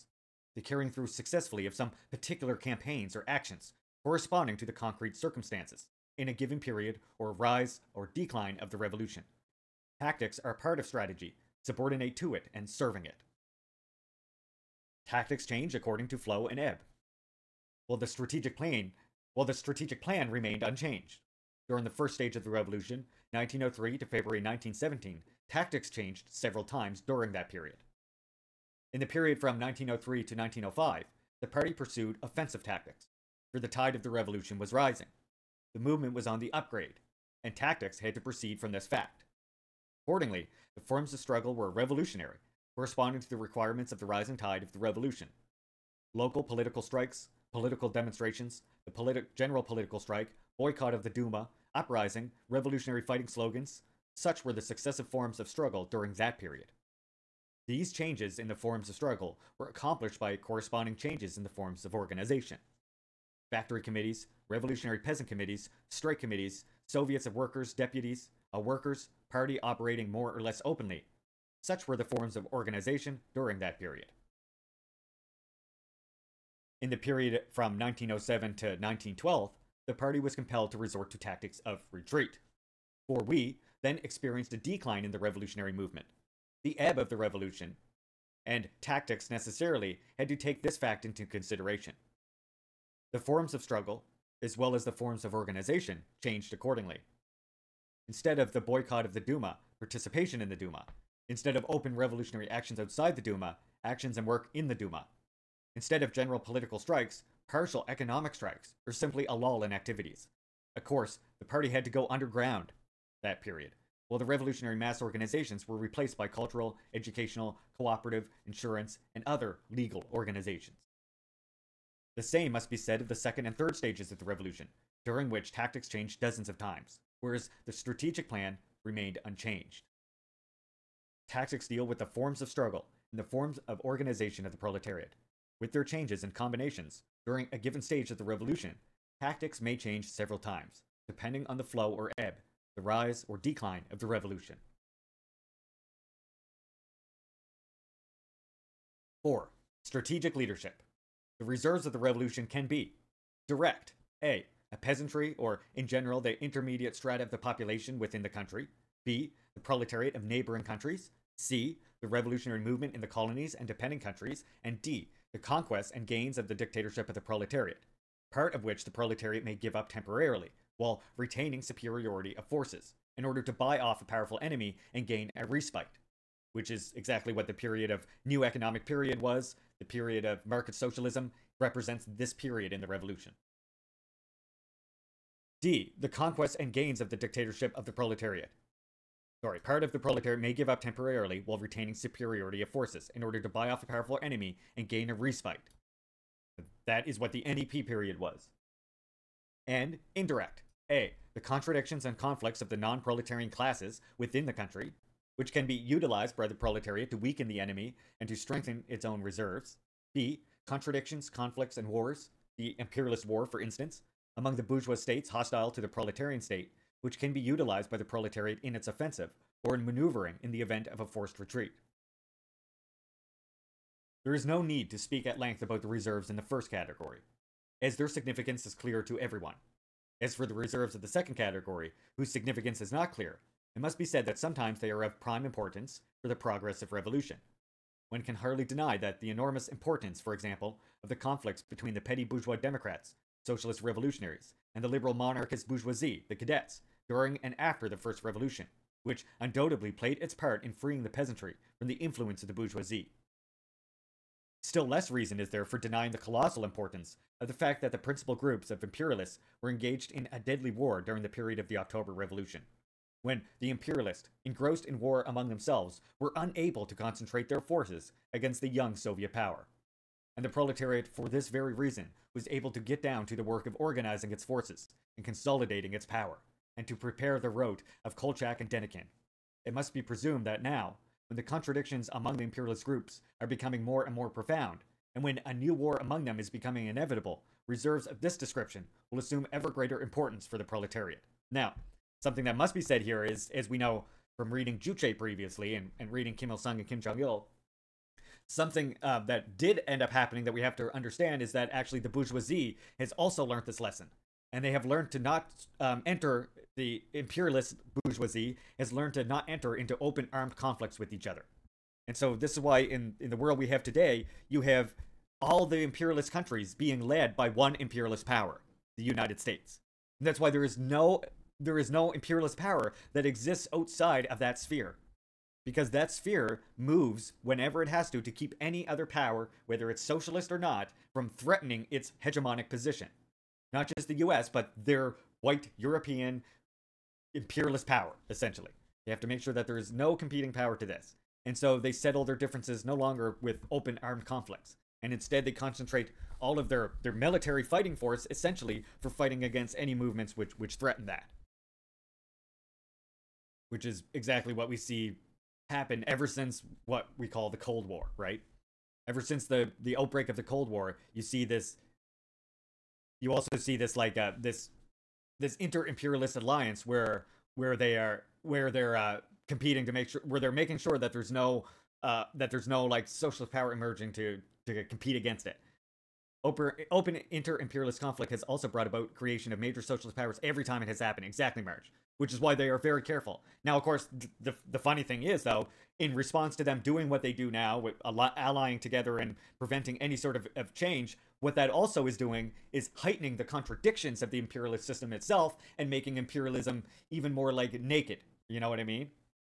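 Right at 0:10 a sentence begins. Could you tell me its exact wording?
Tactics are part of strategy, subordinate to it and serving it.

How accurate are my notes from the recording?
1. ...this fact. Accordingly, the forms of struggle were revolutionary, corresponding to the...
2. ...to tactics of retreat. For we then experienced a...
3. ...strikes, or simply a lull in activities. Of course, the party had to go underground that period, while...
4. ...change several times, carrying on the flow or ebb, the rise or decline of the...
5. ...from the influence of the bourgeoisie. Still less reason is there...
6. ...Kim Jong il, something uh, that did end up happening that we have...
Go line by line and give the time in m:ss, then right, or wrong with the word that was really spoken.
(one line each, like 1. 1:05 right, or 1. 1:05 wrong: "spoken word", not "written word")
1. 0:38 right
2. 1:21 right
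3. 1:48 right
4. 2:19 wrong: "depending", not "carrying"
5. 4:11 right
6. 4:56 right.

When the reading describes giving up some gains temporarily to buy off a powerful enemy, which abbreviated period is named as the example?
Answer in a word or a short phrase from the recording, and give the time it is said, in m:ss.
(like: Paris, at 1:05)
NEP, at 3:17.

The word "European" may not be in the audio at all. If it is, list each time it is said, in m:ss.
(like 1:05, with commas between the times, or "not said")
5:35.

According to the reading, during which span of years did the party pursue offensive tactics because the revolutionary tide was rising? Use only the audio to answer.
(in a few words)
1903 to 1905.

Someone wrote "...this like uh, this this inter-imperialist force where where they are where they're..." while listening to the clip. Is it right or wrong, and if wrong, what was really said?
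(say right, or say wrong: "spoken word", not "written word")
wrong: "alliance", not "force".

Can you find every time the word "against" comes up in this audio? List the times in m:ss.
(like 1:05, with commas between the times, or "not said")
4:28, 5:49, 6:15.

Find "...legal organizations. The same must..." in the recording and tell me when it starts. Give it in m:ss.
1:59.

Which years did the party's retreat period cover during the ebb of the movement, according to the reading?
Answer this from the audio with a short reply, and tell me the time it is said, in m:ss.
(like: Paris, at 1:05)
1907 to 1912, at 1:17.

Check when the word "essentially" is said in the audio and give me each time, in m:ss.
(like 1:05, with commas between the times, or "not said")
5:38, 5:48.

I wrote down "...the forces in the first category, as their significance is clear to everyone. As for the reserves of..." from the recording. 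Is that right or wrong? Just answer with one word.
wrong.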